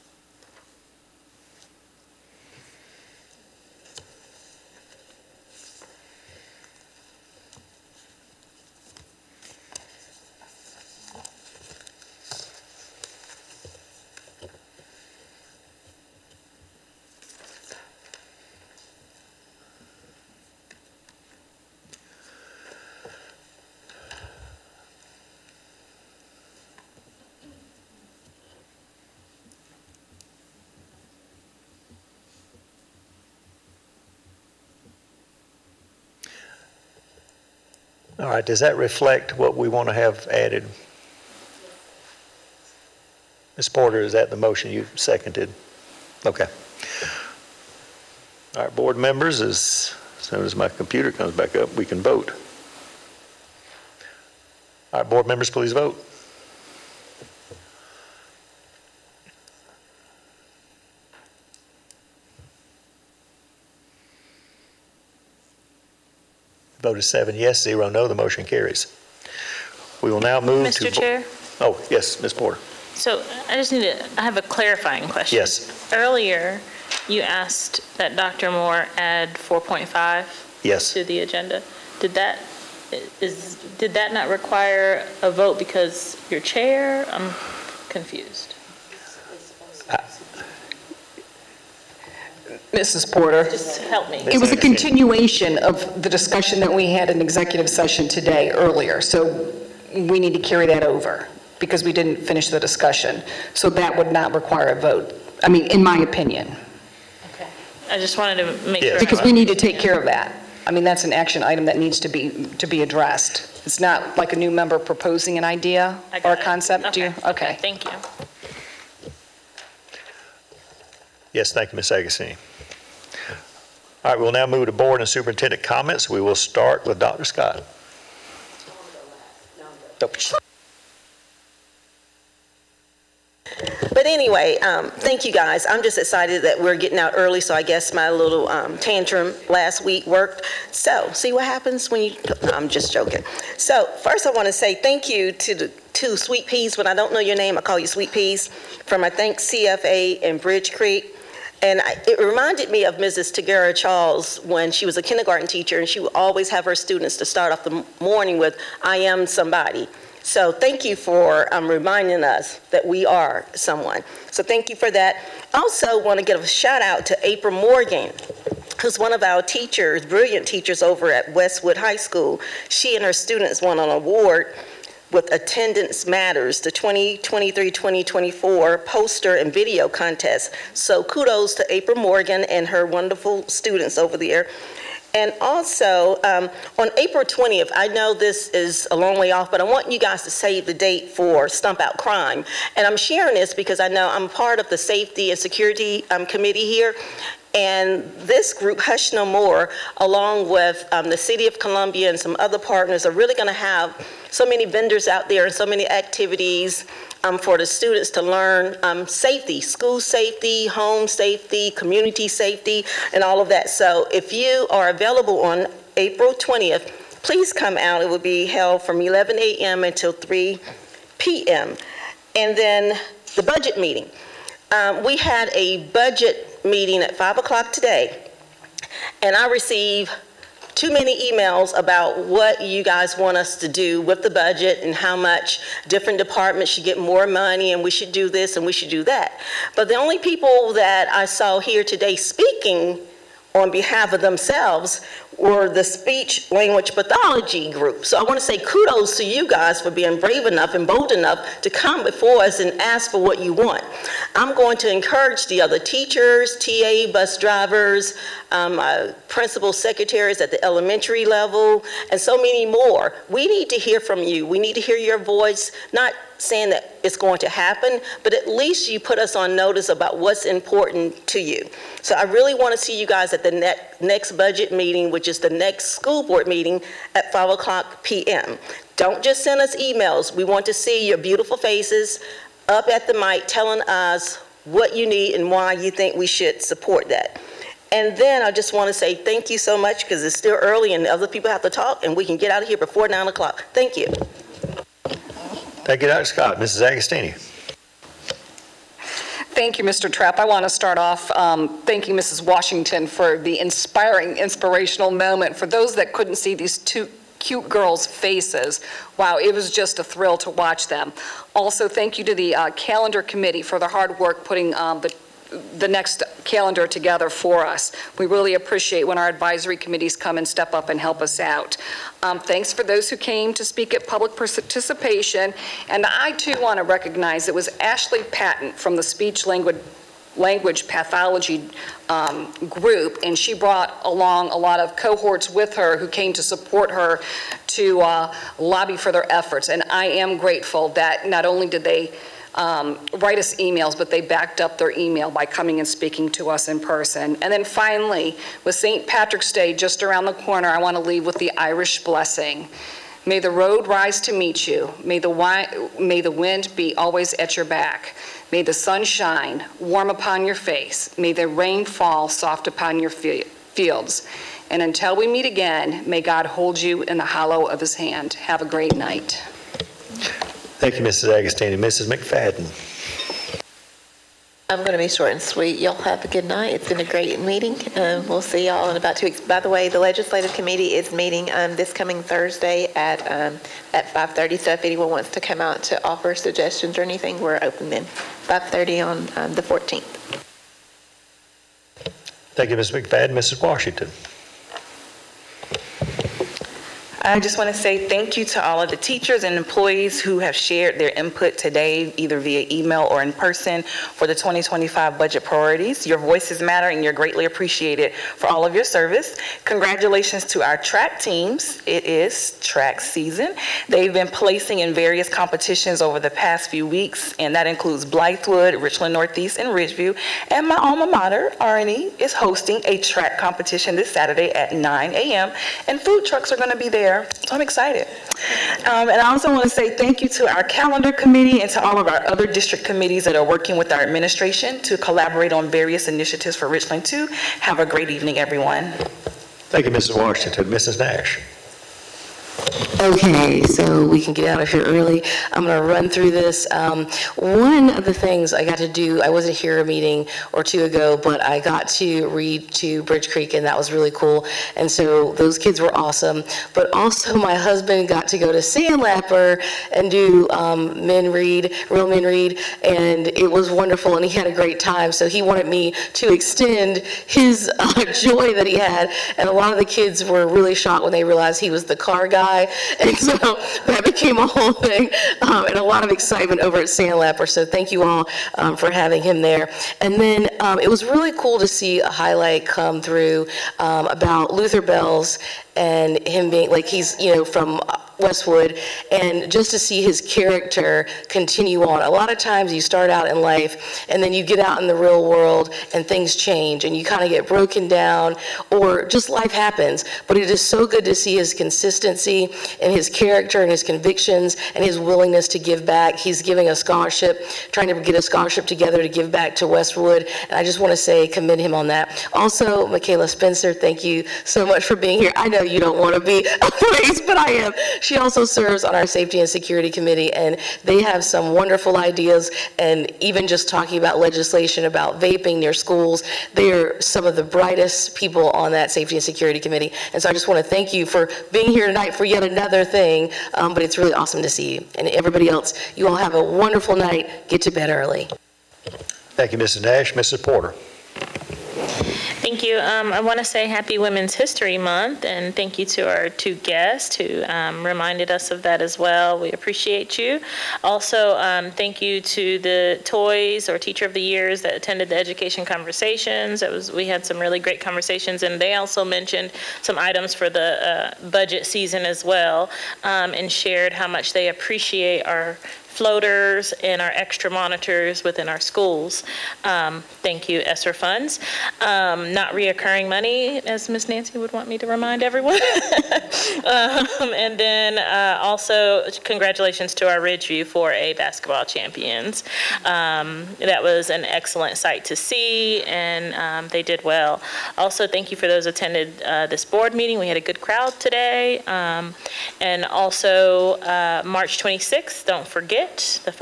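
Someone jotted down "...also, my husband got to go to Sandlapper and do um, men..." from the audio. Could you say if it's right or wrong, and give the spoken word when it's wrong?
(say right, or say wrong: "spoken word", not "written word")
right.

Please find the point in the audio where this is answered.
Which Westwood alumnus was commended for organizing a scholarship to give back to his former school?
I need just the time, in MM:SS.
08:04.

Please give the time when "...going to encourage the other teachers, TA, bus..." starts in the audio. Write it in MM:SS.
04:14.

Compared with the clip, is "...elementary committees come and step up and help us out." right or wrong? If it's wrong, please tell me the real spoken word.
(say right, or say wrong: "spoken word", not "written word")
wrong: "advisory", not "elementary".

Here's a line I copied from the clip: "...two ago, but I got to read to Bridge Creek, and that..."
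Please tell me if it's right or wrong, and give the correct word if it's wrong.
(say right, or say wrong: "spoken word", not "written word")
right.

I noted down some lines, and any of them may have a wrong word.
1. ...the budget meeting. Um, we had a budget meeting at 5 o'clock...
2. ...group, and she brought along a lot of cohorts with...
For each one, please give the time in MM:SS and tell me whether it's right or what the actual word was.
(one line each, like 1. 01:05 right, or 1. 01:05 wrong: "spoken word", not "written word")
1. 03:43 right
2. 05:32 right.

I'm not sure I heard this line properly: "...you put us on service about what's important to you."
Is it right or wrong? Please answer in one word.
wrong.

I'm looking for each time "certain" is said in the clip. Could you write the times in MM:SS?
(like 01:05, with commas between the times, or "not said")
not said.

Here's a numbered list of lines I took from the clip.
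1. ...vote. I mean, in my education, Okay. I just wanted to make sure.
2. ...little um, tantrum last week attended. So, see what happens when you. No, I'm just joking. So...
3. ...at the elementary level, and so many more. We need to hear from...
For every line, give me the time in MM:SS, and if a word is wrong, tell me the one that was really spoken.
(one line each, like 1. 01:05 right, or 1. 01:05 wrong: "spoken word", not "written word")
1. 01:44 wrong: "opinion", not "education"
2. 02:18 wrong: "worked", not "attended"
3. 04:20 right.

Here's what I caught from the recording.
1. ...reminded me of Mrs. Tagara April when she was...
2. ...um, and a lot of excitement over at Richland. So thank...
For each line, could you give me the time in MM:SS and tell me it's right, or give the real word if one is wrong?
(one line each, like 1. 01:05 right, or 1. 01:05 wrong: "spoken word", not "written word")
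1. 02:32 wrong: "Charles", not "April"
2. 07:55 wrong: "Sandlapper", not "Richland".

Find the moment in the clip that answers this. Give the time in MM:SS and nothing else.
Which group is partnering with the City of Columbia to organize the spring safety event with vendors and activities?
03:18.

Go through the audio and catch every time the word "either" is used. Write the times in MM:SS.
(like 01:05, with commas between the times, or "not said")
06:42.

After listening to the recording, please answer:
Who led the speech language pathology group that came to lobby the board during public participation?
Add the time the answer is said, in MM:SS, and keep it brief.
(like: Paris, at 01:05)
Ashley Patton, at 05:27.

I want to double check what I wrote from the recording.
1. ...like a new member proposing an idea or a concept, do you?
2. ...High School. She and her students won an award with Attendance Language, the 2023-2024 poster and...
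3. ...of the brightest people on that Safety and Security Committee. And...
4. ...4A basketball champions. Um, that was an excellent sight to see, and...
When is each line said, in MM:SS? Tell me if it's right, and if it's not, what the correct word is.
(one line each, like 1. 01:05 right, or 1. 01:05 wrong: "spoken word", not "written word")
1. 01:54 right
2. 02:51 wrong: "Matters", not "Language"
3. 08:47 right
4. 09:40 right.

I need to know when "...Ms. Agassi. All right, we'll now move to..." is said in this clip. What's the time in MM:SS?
02:01.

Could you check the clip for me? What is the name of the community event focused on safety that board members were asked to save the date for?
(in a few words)
Stump Out Crime.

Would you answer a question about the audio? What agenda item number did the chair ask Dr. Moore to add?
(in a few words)
4.5.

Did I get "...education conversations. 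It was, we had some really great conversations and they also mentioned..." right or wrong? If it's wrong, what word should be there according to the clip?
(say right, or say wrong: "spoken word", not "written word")
right.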